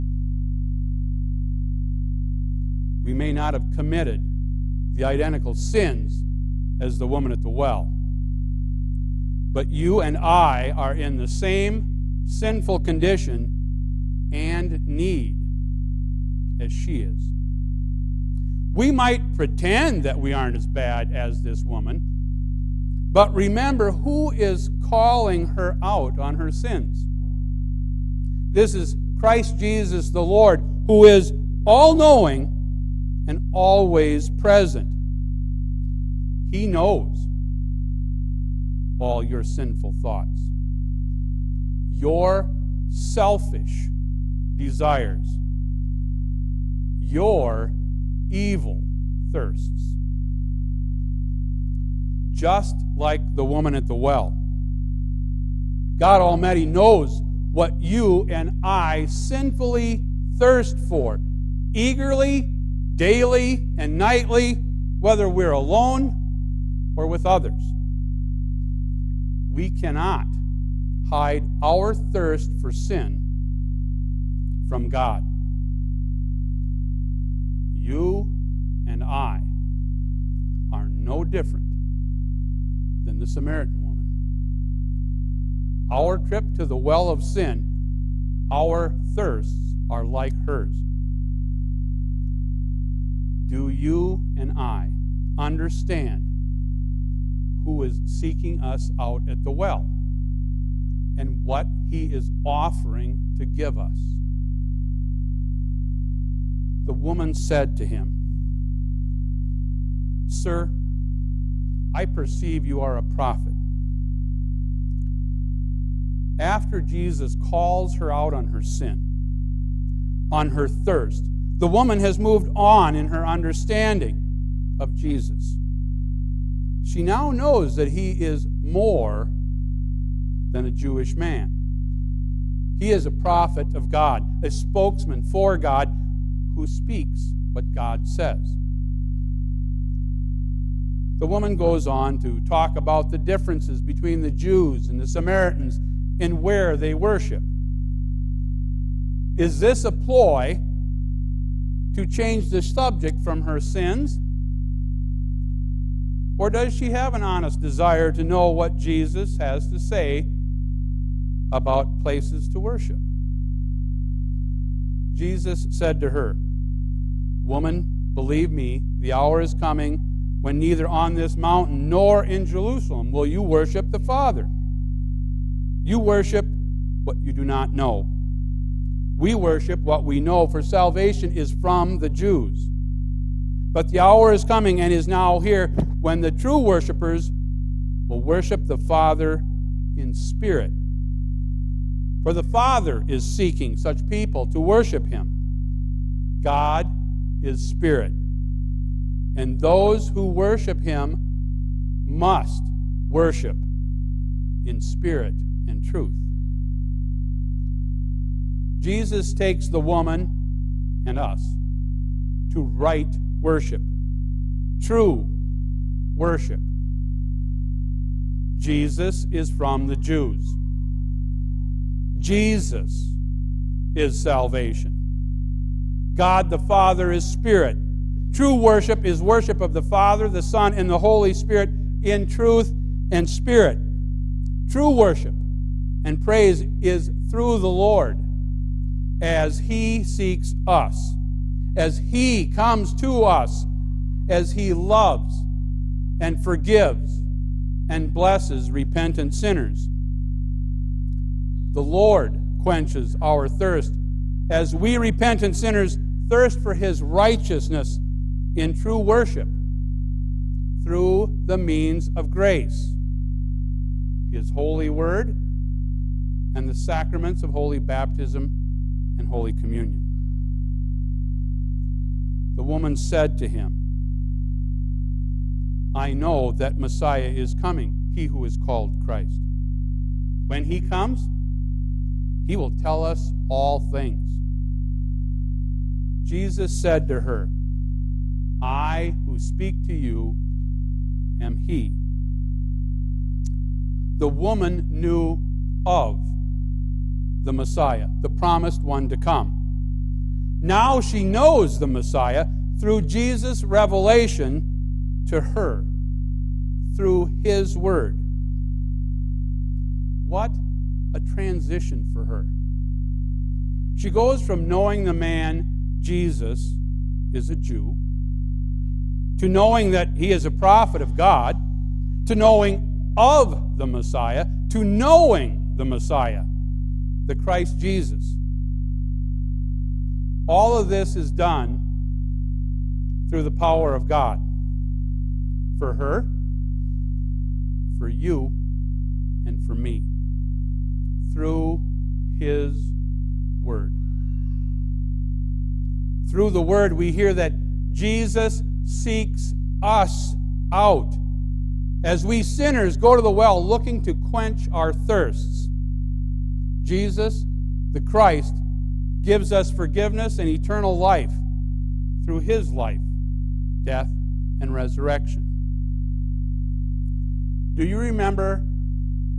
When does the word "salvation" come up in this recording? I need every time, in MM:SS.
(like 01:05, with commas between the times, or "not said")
03:00, 03:44.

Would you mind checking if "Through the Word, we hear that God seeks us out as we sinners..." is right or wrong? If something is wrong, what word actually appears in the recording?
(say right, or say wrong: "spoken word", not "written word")
wrong: "Jesus", not "God".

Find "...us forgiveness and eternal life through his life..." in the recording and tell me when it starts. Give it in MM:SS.
05:59.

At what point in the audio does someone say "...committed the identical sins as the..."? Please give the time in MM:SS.
00:03.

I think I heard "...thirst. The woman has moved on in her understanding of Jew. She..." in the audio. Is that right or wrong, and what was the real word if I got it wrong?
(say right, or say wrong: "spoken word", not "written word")
wrong: "Jesus", not "Jew".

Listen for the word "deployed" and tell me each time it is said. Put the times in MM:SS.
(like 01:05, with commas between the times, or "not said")
not said.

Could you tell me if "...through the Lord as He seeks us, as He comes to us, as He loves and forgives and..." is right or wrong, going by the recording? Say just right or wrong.
right.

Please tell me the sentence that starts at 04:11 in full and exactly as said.
The Lord quenches our thirst as we repentant sinners thirst for His righteousness in true worship through the means of grace.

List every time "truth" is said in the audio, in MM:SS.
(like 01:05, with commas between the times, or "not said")
03:25, 03:52.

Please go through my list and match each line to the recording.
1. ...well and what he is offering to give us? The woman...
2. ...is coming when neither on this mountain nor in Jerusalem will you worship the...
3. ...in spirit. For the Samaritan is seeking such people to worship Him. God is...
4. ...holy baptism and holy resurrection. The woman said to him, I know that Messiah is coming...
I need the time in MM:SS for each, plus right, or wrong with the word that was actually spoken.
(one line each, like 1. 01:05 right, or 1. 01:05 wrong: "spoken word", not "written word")
1. 01:39 right
2. 02:49 right
3. 03:09 wrong: "Father", not "Samaritan"
4. 04:27 wrong: "communion", not "resurrection".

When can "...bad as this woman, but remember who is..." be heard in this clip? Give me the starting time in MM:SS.
00:20.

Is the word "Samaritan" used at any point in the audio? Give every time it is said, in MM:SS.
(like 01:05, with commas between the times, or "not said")
01:23, 02:25.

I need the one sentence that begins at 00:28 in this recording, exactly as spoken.
This is Christ Jesus the Lord, who is all knowing and always present.